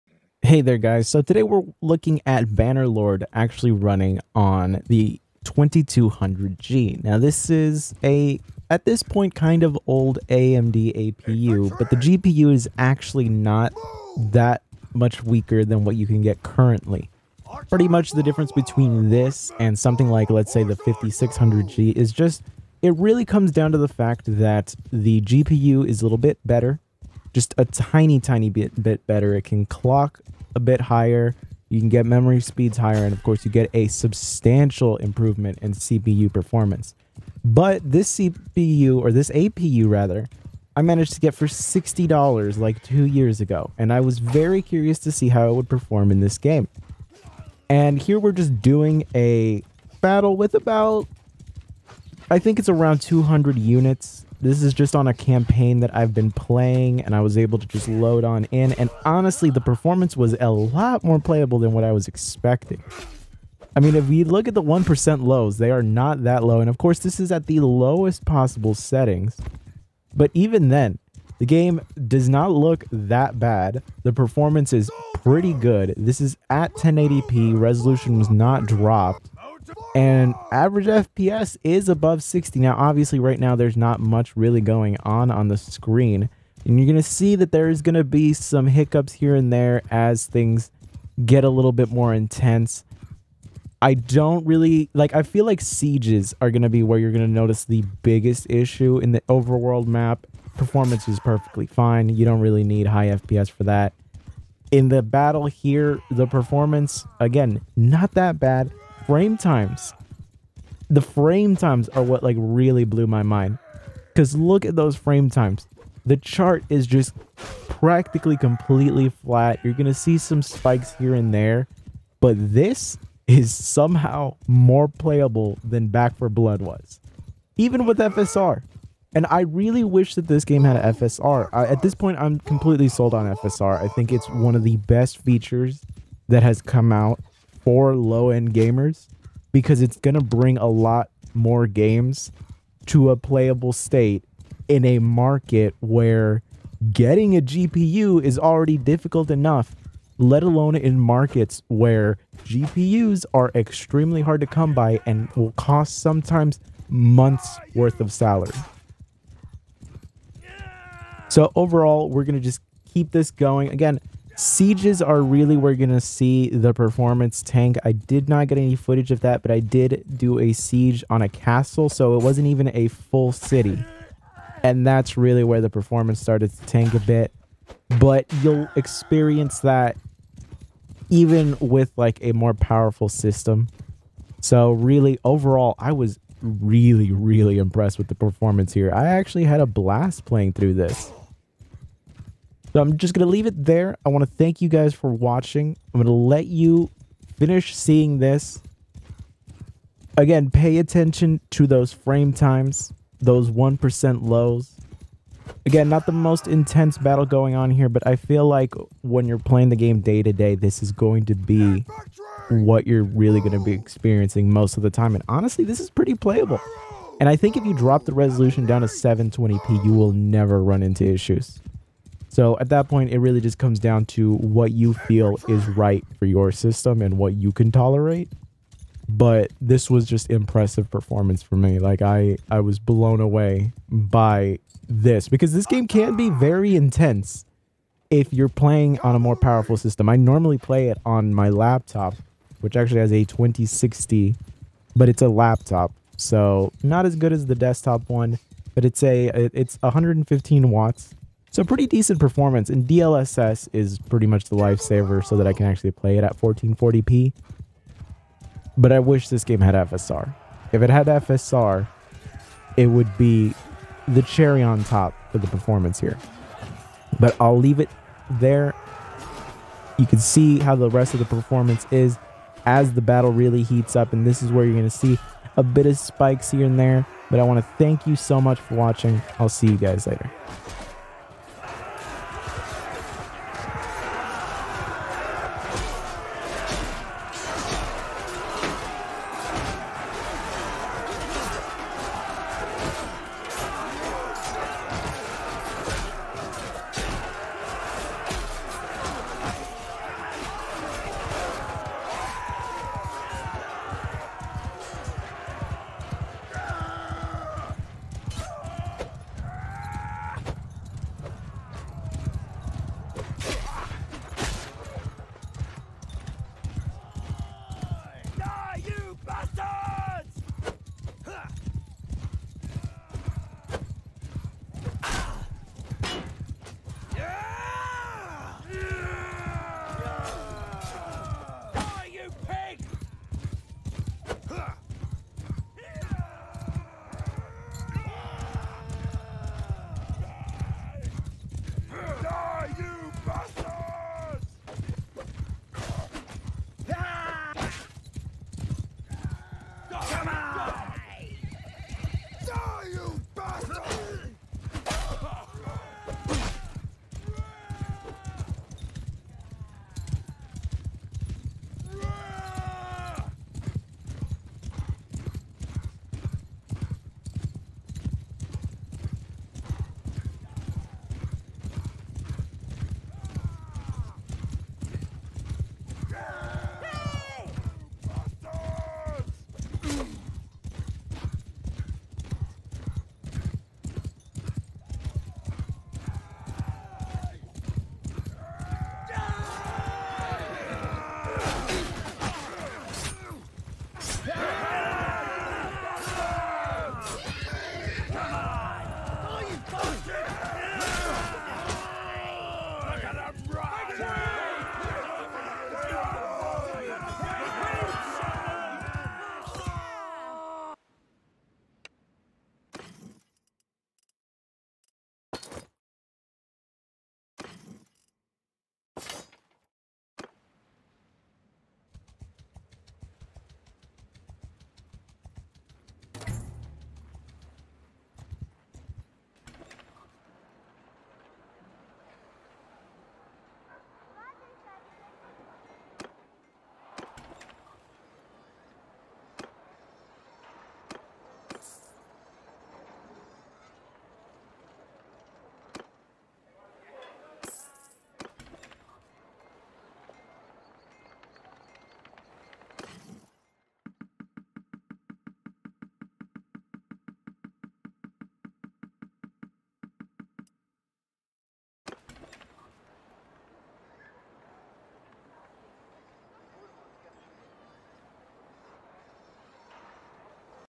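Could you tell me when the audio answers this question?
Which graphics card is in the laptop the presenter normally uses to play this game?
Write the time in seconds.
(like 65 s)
243 s.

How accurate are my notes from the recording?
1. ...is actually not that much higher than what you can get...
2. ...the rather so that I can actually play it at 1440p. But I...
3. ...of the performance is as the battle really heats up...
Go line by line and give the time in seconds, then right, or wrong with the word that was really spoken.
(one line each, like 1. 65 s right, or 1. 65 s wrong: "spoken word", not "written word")
1. 12 s wrong: "weaker", not "higher"
2. 254 s wrong: "lifesaver", not "rather"
3. 271 s right.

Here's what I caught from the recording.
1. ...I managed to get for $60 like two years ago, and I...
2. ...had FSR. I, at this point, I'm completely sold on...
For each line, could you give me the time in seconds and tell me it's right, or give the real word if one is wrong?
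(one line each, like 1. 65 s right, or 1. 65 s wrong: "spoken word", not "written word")
1. 40 s right
2. 130 s right.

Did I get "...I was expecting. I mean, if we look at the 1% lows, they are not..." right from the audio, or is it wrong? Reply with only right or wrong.
right.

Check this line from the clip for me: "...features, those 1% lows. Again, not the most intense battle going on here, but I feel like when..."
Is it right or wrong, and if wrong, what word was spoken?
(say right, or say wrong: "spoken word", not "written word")
wrong: "times", not "features".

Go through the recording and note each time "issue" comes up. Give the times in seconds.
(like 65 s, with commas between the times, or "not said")
98 s, 221 s.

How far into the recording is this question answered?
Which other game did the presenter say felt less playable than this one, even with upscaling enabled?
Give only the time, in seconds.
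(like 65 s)
125 s.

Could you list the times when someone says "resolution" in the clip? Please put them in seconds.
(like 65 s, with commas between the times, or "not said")
77 s, 218 s.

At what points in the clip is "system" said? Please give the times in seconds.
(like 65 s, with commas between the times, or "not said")
183 s, 226 s, 239 s.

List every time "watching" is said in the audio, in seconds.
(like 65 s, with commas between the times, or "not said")
195 s, 278 s.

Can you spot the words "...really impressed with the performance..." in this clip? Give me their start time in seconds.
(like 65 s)
187 s.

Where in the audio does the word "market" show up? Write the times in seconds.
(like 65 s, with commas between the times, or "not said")
144 s, 150 s.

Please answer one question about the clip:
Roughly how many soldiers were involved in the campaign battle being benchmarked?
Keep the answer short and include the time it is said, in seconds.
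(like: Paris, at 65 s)
200, at 53 s.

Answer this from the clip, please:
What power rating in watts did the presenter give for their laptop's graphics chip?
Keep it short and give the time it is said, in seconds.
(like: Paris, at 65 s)
115 watts, at 249 s.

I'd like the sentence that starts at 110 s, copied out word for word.
The frame times are what like really blew my mind.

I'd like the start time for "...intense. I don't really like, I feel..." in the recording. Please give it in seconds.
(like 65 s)
92 s.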